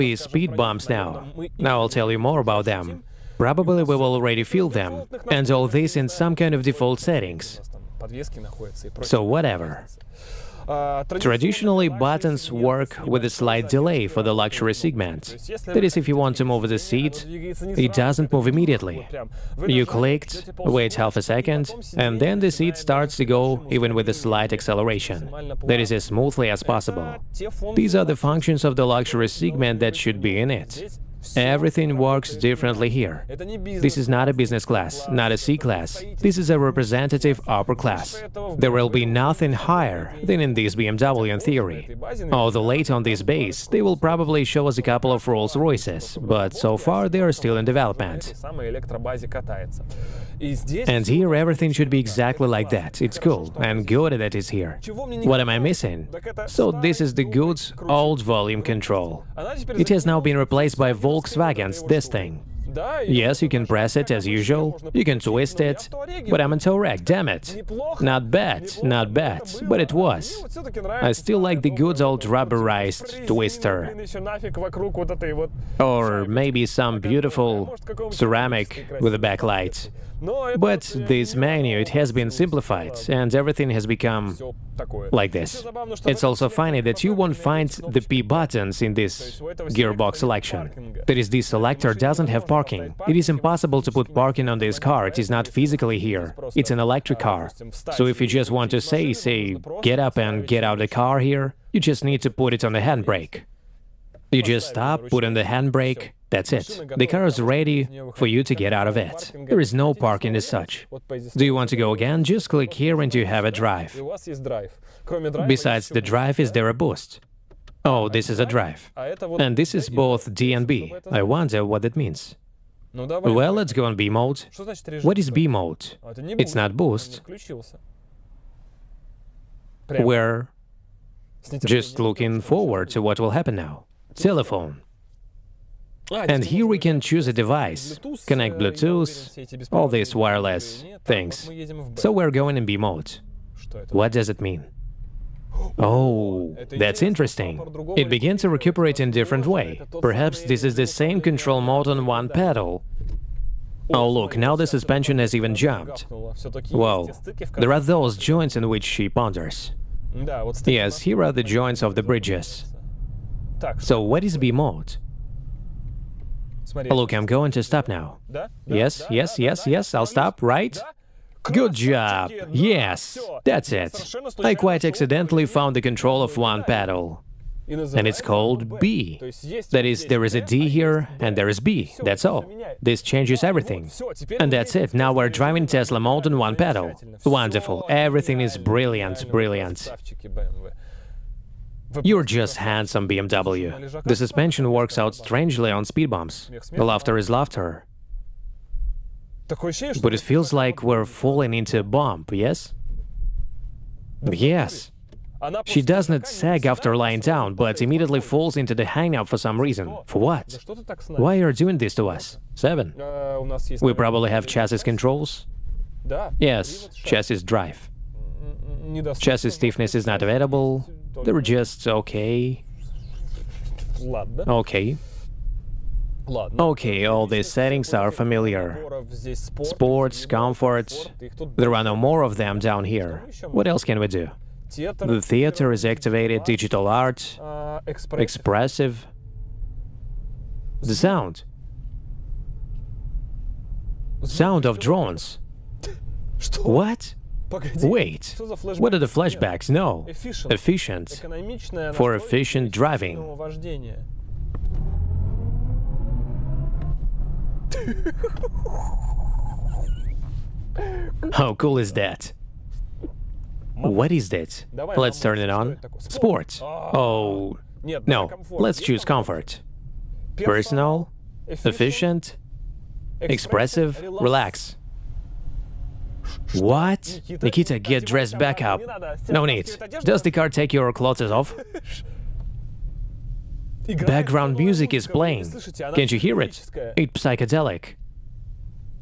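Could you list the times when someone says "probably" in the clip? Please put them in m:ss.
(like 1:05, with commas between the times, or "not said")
0:03, 0:43, 3:33.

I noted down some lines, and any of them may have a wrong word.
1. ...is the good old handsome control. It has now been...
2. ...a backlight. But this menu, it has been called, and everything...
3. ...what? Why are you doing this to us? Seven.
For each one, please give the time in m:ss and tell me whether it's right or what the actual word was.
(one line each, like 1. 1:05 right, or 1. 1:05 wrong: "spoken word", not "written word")
1. 0:57 wrong: "volume", not "handsome"
2. 1:19 wrong: "simplified", not "called"
3. 3:30 right.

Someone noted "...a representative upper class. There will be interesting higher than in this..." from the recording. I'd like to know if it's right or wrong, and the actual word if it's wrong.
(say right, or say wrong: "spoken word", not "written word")
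wrong: "nothing", not "interesting".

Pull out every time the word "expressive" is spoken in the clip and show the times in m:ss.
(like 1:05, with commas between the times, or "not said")
3:57, 4:33.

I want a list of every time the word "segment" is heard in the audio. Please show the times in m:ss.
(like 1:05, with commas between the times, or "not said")
0:14, 0:29.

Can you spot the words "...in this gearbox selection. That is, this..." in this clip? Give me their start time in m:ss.
1:28.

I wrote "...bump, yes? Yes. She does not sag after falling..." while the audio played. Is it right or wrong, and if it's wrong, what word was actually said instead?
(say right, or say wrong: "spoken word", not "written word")
wrong: "lying", not "falling".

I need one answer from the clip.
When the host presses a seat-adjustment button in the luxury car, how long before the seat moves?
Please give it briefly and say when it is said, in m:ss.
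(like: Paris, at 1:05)
half a second, at 0:20.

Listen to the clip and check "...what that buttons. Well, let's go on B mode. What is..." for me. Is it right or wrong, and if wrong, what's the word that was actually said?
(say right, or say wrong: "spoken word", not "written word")
wrong: "means", not "buttons".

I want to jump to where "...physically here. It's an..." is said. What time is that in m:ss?
1:35.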